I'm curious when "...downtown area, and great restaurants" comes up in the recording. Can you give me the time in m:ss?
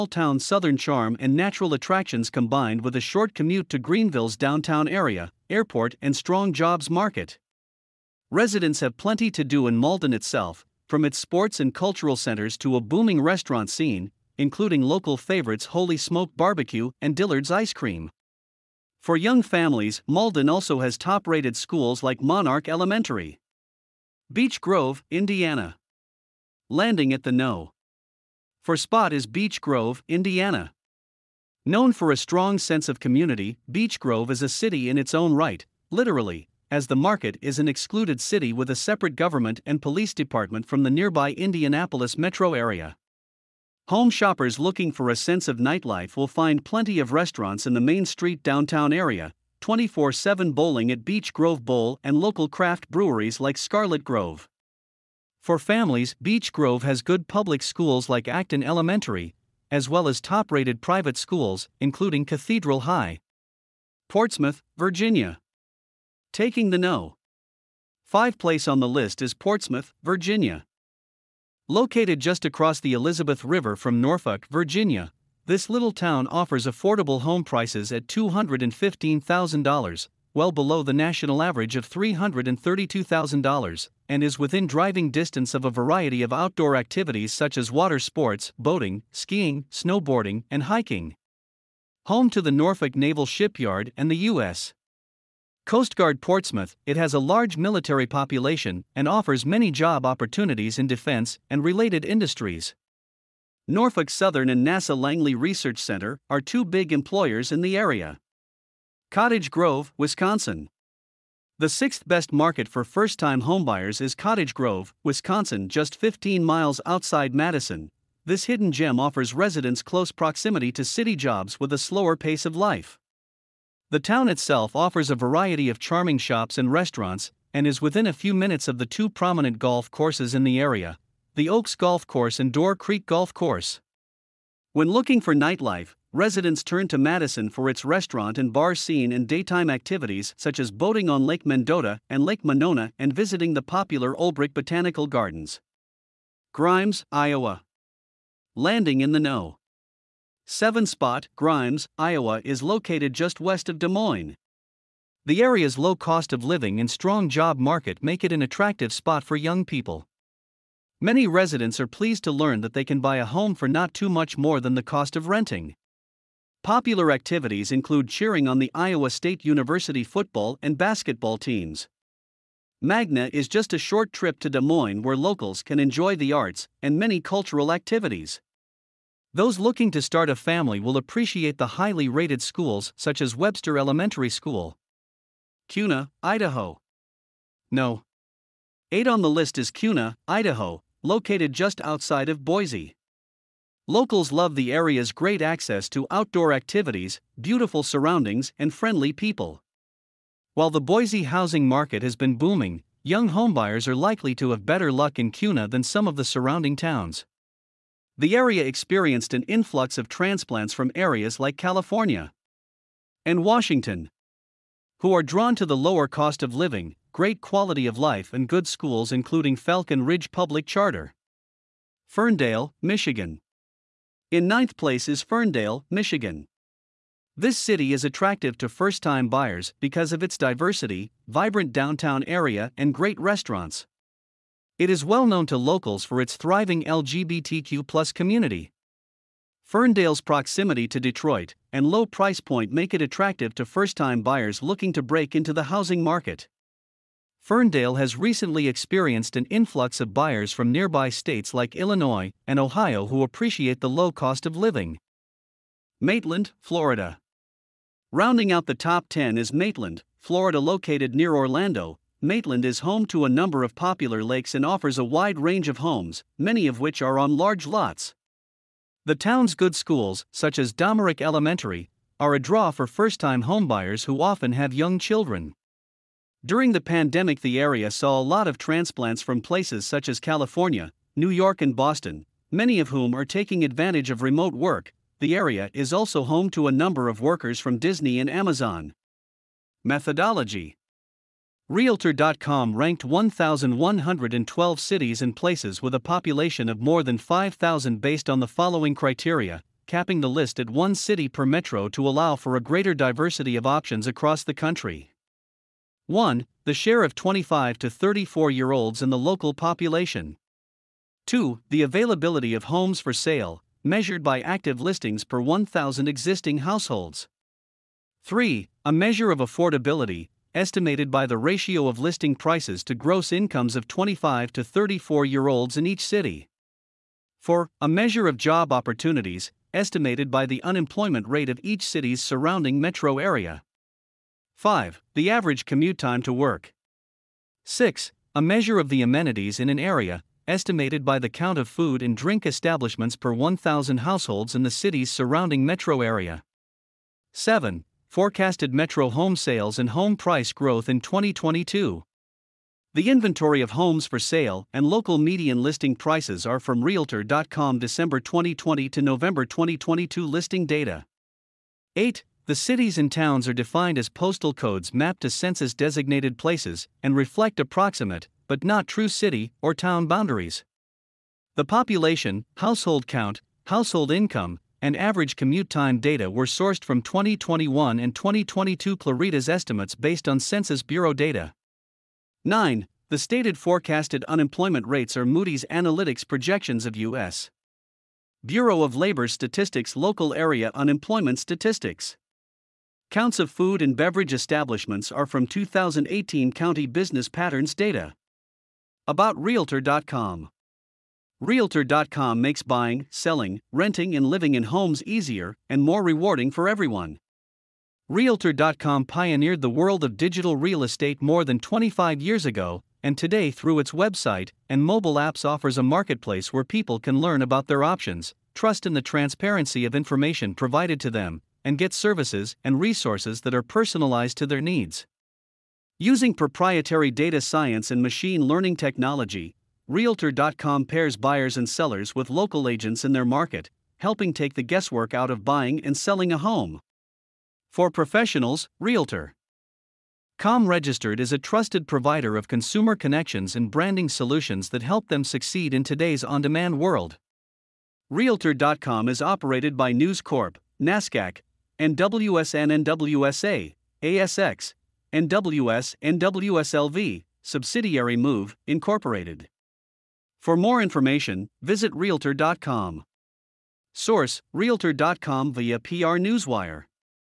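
3:51.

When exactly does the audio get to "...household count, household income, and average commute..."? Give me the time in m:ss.
6:12.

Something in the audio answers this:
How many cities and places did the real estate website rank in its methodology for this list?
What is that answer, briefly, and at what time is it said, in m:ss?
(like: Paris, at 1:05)
1,112, at 4:53.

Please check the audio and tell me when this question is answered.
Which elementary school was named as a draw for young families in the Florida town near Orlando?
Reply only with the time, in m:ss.
4:30.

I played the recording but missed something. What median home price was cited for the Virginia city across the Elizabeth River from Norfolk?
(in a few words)
$215,000.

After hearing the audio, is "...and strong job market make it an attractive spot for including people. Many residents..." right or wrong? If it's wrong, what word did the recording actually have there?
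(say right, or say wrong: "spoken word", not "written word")
wrong: "young", not "including".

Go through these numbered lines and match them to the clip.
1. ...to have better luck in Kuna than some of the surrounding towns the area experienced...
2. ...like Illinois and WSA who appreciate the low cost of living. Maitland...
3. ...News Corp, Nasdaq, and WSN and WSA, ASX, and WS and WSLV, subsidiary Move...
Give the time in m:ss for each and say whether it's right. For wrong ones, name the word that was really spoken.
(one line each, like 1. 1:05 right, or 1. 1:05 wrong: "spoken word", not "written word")
1. 3:24 right
2. 4:11 wrong: "Ohio", not "WSA"
3. 7:29 right.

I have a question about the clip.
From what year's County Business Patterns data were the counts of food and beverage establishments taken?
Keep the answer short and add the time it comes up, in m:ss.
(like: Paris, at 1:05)
2018, at 6:35.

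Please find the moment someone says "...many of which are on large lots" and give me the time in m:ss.
4:26.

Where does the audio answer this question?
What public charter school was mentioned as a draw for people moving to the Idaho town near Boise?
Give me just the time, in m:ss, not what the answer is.
3:39.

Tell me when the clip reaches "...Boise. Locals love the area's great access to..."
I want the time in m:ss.
3:12.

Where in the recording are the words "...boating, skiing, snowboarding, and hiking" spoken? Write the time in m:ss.
1:28.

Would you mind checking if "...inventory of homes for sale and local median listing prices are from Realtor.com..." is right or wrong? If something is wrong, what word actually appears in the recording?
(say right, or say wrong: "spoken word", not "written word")
right.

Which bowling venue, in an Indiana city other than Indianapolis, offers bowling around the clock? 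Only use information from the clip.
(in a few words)
Beech Grove Bowl.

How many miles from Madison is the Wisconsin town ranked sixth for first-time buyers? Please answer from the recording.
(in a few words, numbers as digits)
15.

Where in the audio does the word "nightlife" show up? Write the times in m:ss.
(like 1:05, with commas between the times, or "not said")
0:45, 2:15.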